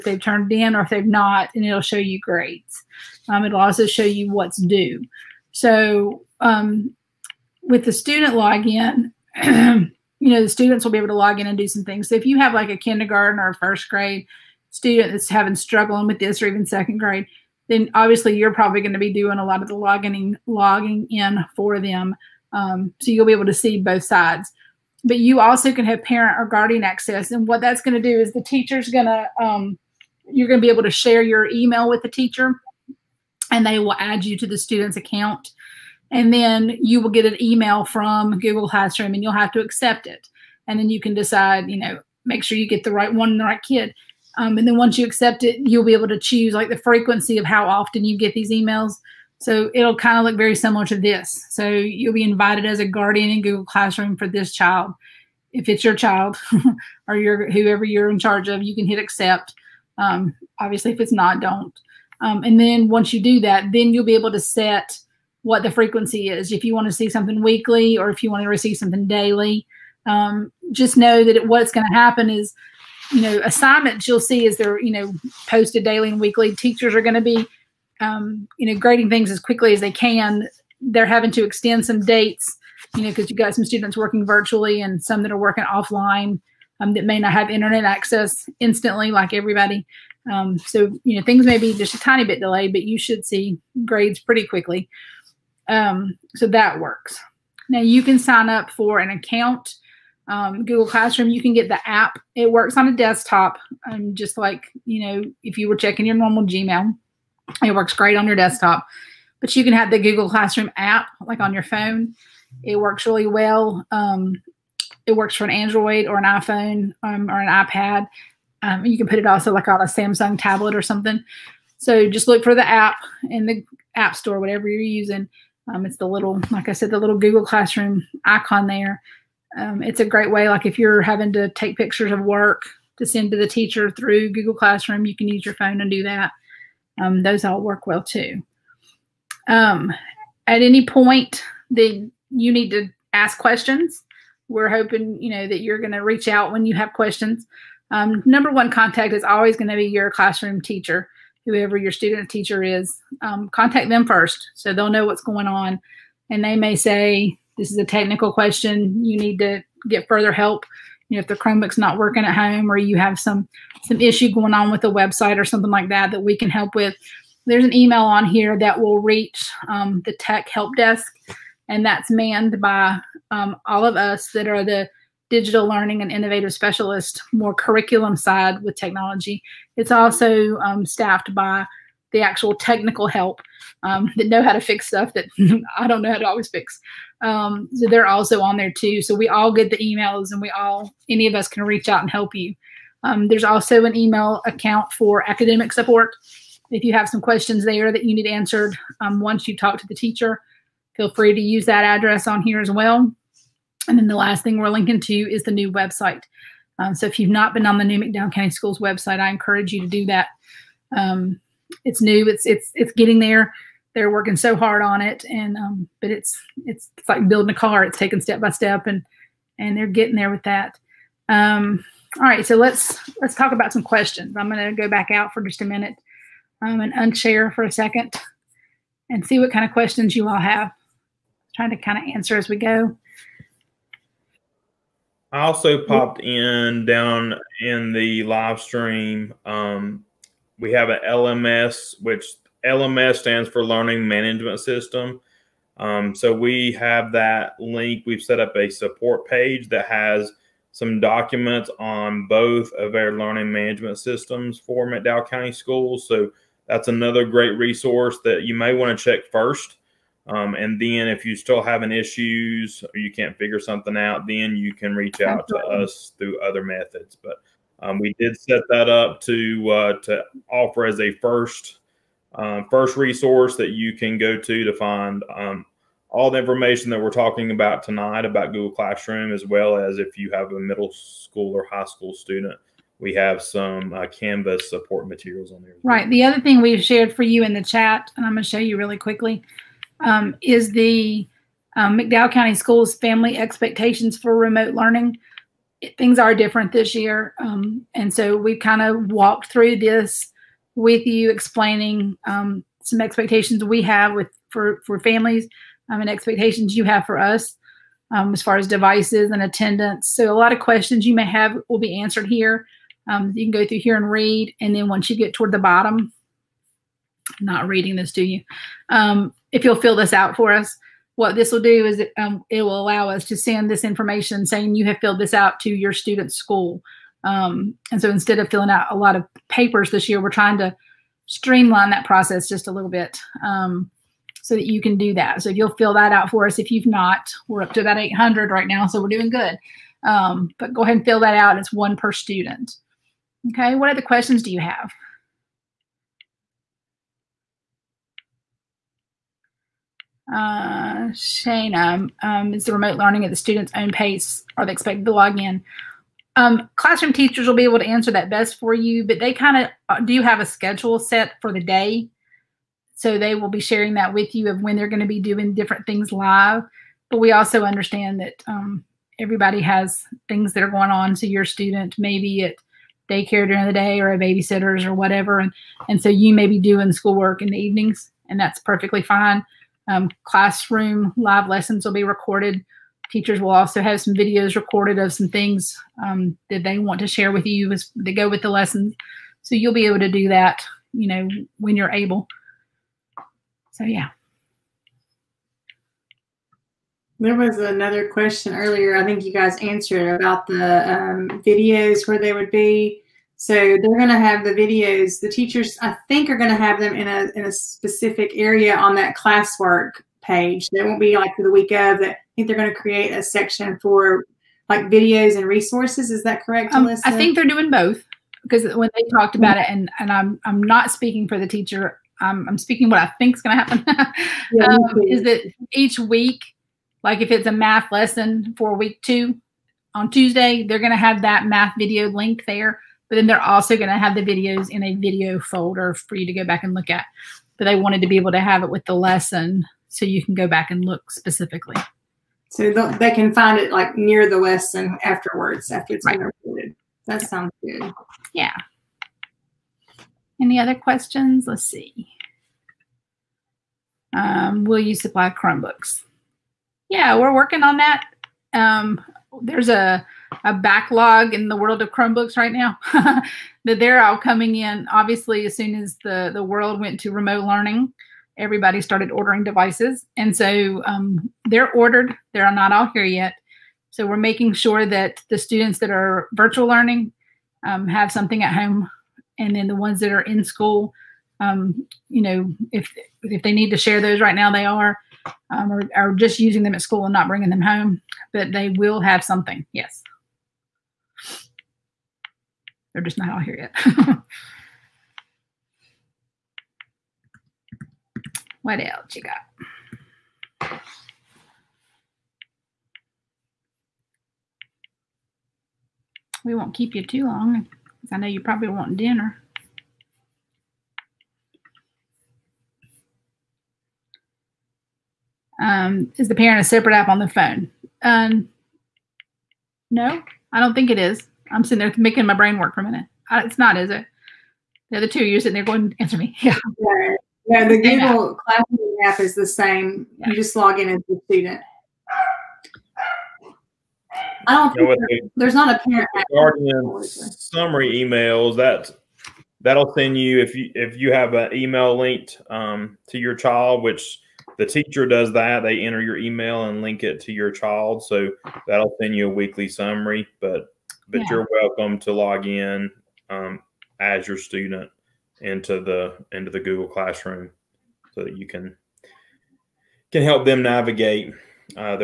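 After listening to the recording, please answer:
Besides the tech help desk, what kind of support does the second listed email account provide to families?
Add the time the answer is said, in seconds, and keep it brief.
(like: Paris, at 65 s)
academic support, at 195 s.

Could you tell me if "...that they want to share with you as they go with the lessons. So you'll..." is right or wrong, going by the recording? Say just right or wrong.
right.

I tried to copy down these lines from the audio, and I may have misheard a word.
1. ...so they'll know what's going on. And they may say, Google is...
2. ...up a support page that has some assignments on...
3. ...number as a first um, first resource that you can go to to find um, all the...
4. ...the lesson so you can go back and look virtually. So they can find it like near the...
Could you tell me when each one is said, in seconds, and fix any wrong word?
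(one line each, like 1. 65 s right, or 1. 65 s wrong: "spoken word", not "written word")
1. 154 s wrong: "This", not "Google"
2. 248 s wrong: "documents", not "assignments"
3. 270 s wrong: "offer", not "number"
4. 438 s wrong: "specifically", not "virtually".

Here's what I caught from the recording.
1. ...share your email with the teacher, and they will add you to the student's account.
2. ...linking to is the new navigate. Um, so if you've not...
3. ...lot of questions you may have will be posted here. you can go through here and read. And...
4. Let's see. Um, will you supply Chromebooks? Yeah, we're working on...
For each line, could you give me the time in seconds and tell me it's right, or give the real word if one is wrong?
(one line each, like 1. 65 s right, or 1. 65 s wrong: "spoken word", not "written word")
1. 30 s right
2. 204 s wrong: "website", not "navigate"
3. 310 s wrong: "answered", not "posted"
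4. 451 s right.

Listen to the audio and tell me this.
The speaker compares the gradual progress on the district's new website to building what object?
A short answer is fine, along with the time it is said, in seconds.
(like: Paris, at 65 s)
a car, at 217 s.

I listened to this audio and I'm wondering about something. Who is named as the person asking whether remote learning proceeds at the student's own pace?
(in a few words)
Shana.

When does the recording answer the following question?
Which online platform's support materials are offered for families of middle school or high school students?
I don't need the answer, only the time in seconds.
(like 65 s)
284 s.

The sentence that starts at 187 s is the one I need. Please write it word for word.
Um, so they're also on there too.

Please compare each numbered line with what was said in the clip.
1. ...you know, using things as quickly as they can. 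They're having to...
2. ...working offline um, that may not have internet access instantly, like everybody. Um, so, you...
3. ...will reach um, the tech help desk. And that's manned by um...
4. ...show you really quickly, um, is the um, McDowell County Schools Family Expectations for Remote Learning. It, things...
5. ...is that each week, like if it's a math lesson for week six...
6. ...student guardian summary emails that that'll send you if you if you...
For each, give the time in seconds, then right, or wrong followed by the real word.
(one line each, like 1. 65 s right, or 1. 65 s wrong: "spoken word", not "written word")
1. 78 s wrong: "grading", not "using"
2. 85 s right
3. 168 s right
4. 288 s right
5. 425 s wrong: "two", not "six"
6. 535 s wrong: "parent", not "student".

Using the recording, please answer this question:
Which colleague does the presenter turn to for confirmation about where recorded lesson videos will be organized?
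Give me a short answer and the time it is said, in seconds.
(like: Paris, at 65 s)
Alyssa, at 416 s.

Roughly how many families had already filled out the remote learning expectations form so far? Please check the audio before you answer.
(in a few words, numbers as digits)
800.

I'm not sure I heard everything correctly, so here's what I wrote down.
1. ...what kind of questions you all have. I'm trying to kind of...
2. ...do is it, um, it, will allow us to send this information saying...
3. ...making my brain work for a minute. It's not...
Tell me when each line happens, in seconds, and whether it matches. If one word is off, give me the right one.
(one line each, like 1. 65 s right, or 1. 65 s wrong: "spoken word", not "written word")
1. 229 s right
2. 321 s right
3. 521 s right.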